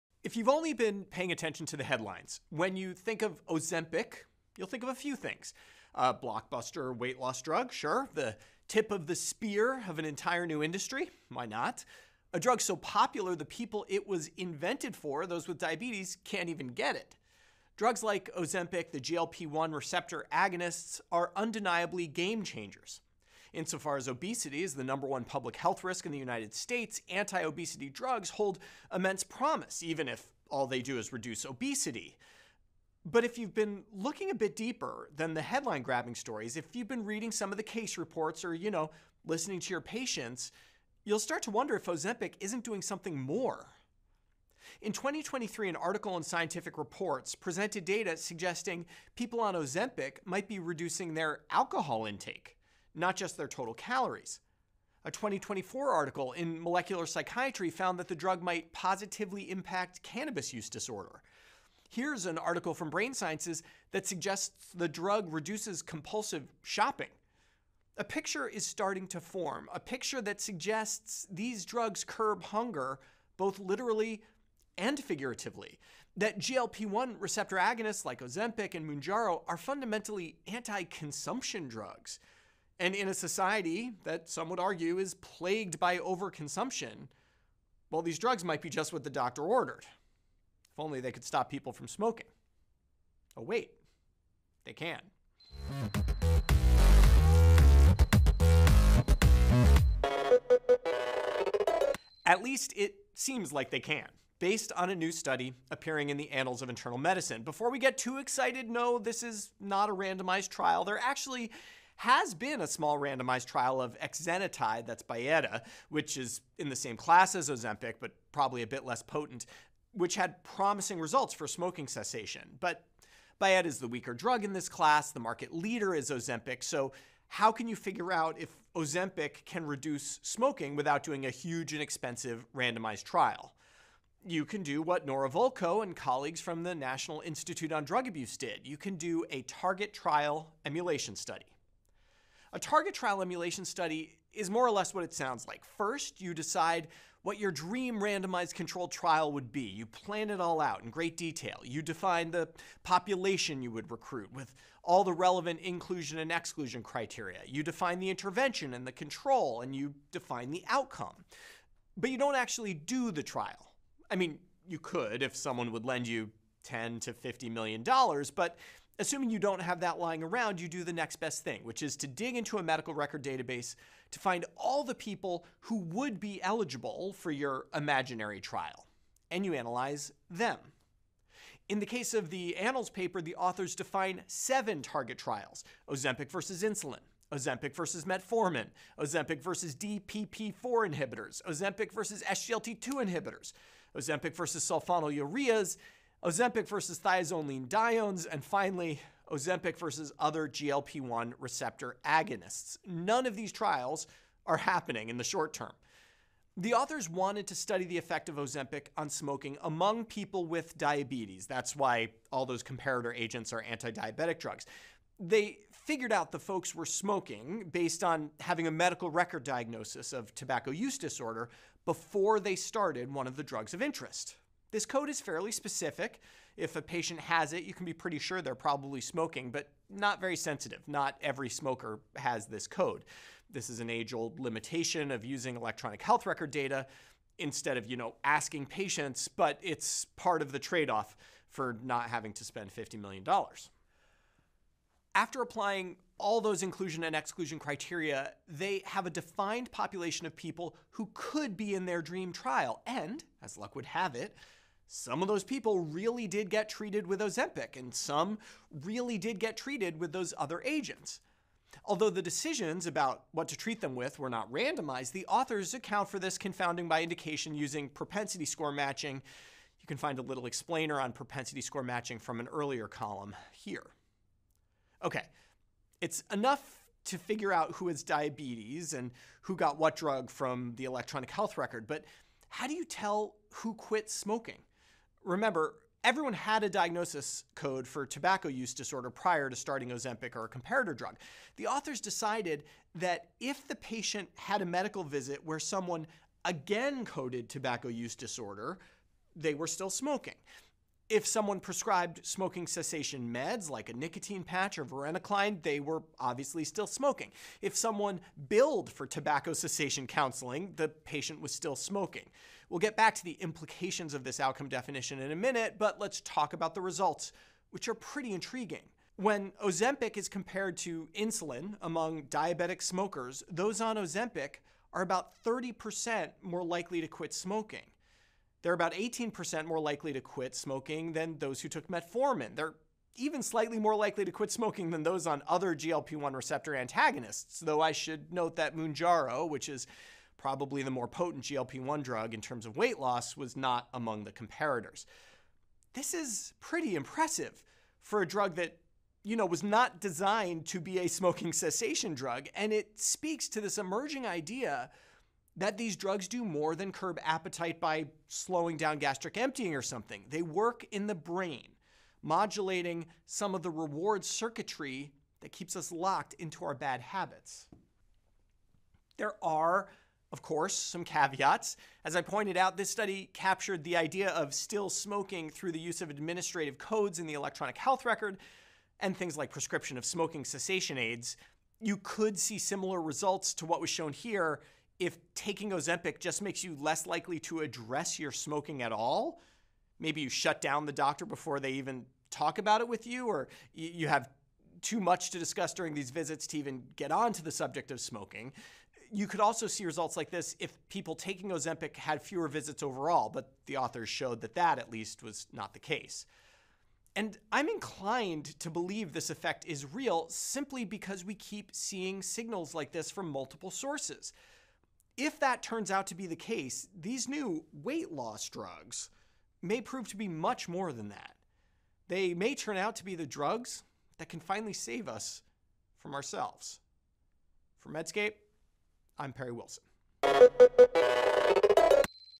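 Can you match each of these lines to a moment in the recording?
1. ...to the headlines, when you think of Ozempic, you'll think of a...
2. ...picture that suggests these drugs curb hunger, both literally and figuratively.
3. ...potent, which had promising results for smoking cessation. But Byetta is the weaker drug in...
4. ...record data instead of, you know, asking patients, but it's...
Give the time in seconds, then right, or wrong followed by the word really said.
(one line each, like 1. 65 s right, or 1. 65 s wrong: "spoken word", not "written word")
1. 1 s right
2. 69 s right
3. 119 s right
4. 236 s right.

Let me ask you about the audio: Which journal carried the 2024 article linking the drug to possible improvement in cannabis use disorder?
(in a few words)
Molecular Psychiatry.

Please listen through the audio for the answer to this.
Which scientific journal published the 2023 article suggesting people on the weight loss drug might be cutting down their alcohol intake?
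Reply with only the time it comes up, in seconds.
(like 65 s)
46 s.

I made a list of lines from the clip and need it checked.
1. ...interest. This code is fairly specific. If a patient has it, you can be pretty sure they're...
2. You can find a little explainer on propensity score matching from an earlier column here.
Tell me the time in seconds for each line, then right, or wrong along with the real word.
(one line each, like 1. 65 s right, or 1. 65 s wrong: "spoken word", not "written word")
1. 223 s right
2. 269 s right.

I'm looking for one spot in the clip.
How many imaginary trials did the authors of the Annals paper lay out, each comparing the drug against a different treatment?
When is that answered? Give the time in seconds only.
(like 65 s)
184 s.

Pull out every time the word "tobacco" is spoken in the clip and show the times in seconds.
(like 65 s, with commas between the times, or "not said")
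220 s, 288 s, 297 s, 309 s.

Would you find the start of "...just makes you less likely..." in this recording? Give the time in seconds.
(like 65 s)
386 s.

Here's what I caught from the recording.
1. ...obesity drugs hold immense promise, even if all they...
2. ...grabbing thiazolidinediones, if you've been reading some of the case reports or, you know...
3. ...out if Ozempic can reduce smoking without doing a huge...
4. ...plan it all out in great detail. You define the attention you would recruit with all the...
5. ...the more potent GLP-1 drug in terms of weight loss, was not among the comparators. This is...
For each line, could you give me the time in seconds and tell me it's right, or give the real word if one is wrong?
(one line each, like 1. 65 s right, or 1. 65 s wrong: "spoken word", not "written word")
1. 27 s right
2. 35 s wrong: "stories", not "thiazolidinediones"
3. 128 s right
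4. 149 s wrong: "population", not "attention"
5. 340 s right.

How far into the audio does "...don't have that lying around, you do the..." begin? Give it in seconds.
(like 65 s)
169 s.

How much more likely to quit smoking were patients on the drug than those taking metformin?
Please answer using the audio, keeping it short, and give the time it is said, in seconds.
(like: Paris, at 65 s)
18%, at 328 s.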